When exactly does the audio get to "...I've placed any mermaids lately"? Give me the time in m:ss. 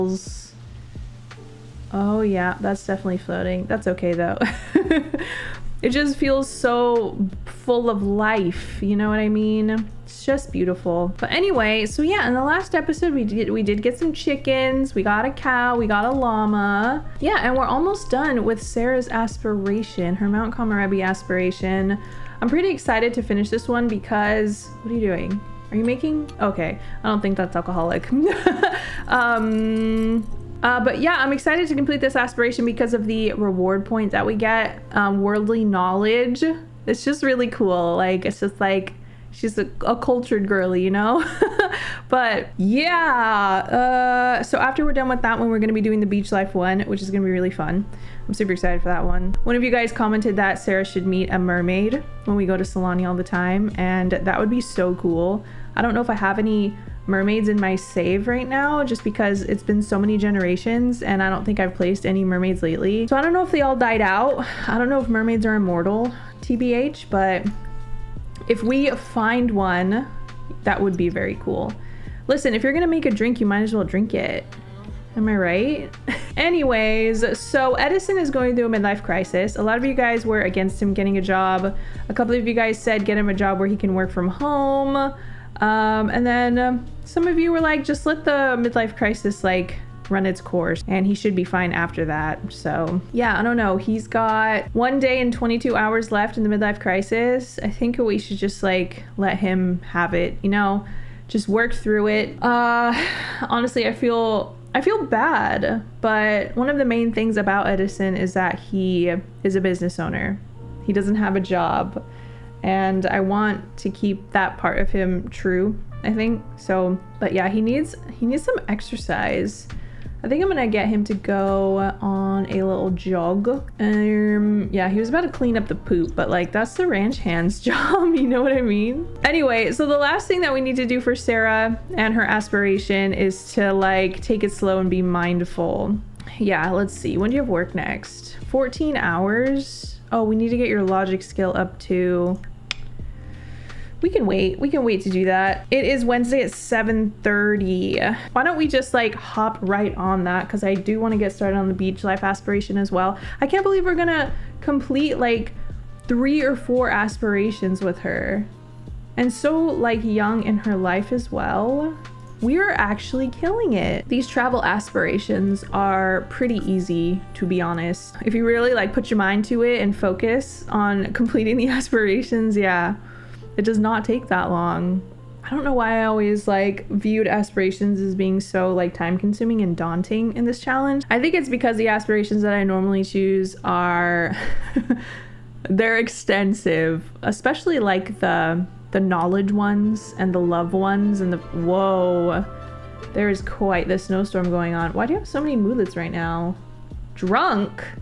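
1:01.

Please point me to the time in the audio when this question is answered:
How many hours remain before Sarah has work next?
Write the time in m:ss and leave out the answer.
2:18.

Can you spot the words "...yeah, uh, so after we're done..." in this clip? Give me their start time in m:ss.
0:42.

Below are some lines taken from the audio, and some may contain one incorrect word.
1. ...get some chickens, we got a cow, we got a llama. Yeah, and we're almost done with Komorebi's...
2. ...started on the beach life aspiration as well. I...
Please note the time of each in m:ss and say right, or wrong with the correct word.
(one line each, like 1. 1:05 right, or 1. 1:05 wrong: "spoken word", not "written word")
1. 0:13 wrong: "Sarah", not "Komorebi"
2. 2:31 right.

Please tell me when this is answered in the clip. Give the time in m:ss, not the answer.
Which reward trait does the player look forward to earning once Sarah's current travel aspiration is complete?
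0:35.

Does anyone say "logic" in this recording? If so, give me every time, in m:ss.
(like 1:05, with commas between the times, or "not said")
2:20.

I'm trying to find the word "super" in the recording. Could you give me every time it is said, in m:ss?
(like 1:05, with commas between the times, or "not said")
0:48.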